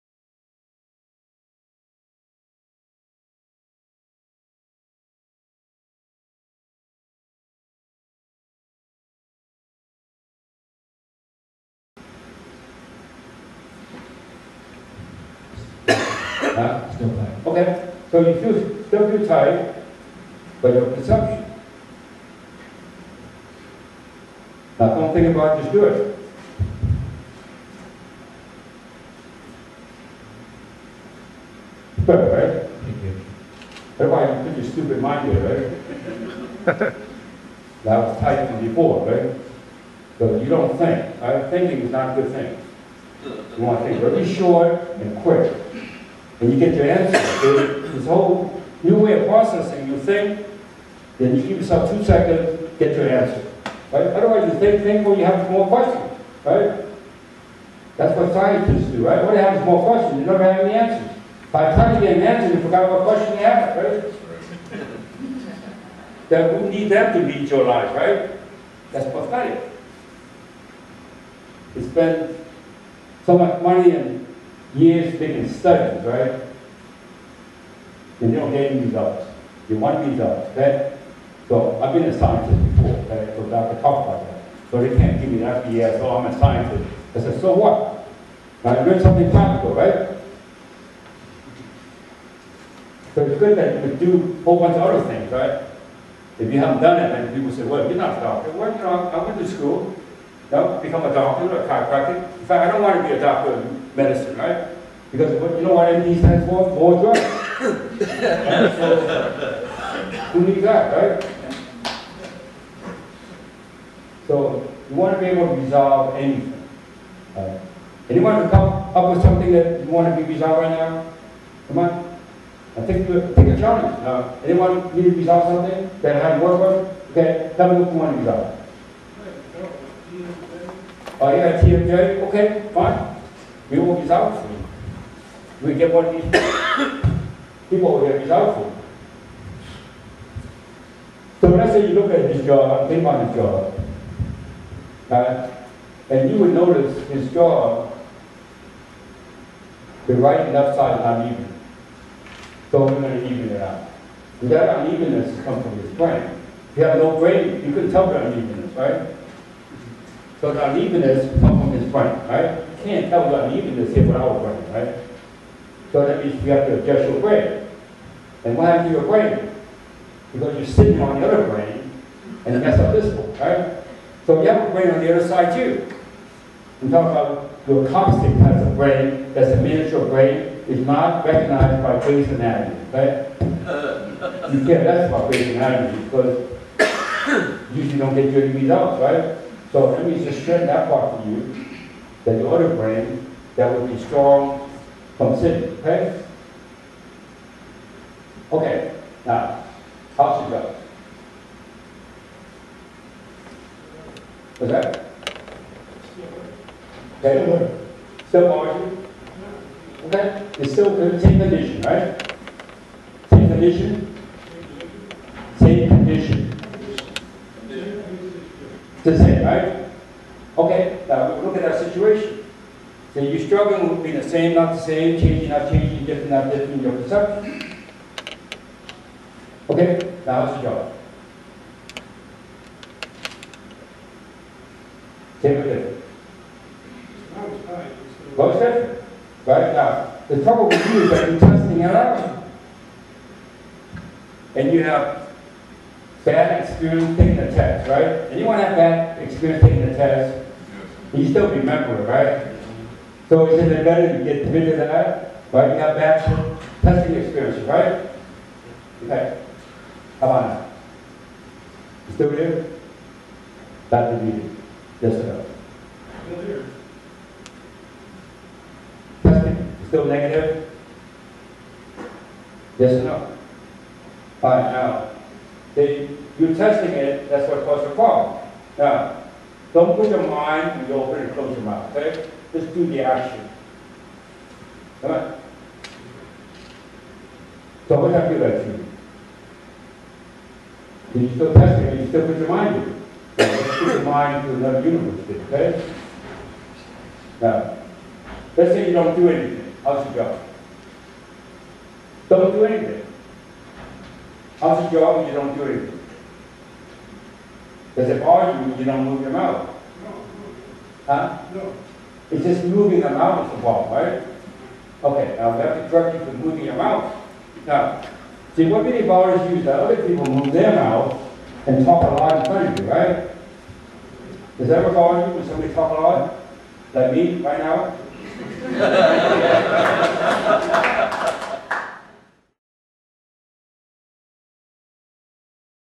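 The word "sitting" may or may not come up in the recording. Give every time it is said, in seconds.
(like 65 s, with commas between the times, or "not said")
170 s, 195 s.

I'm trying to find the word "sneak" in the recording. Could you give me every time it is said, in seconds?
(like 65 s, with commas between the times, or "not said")
not said.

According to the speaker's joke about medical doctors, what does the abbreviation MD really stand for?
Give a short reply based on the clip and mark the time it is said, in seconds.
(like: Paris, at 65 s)
More drugs, at 106 s.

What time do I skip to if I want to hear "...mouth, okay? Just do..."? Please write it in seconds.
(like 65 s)
281 s.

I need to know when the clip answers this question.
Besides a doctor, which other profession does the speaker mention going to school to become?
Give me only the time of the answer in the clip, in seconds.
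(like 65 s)
101 s.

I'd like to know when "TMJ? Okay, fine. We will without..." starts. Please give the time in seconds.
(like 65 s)
131 s.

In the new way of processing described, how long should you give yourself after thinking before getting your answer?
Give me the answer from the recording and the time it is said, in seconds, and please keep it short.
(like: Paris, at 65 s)
2 seconds, at 51 s.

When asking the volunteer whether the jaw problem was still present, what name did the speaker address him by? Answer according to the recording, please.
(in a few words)
Dr. Lee.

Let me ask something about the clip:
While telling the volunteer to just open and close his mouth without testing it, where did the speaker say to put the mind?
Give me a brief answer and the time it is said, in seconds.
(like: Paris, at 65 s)
Another universe, at 294 s.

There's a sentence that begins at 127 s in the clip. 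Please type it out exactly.
Okay, tell me what you want to resolve.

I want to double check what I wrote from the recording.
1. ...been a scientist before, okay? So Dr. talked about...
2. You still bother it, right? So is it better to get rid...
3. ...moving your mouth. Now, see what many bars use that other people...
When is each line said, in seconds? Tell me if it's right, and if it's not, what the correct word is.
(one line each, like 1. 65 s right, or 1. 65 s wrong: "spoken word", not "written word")
1. 81 s right
2. 251 s wrong: "remember", not "bother"
3. 316 s right.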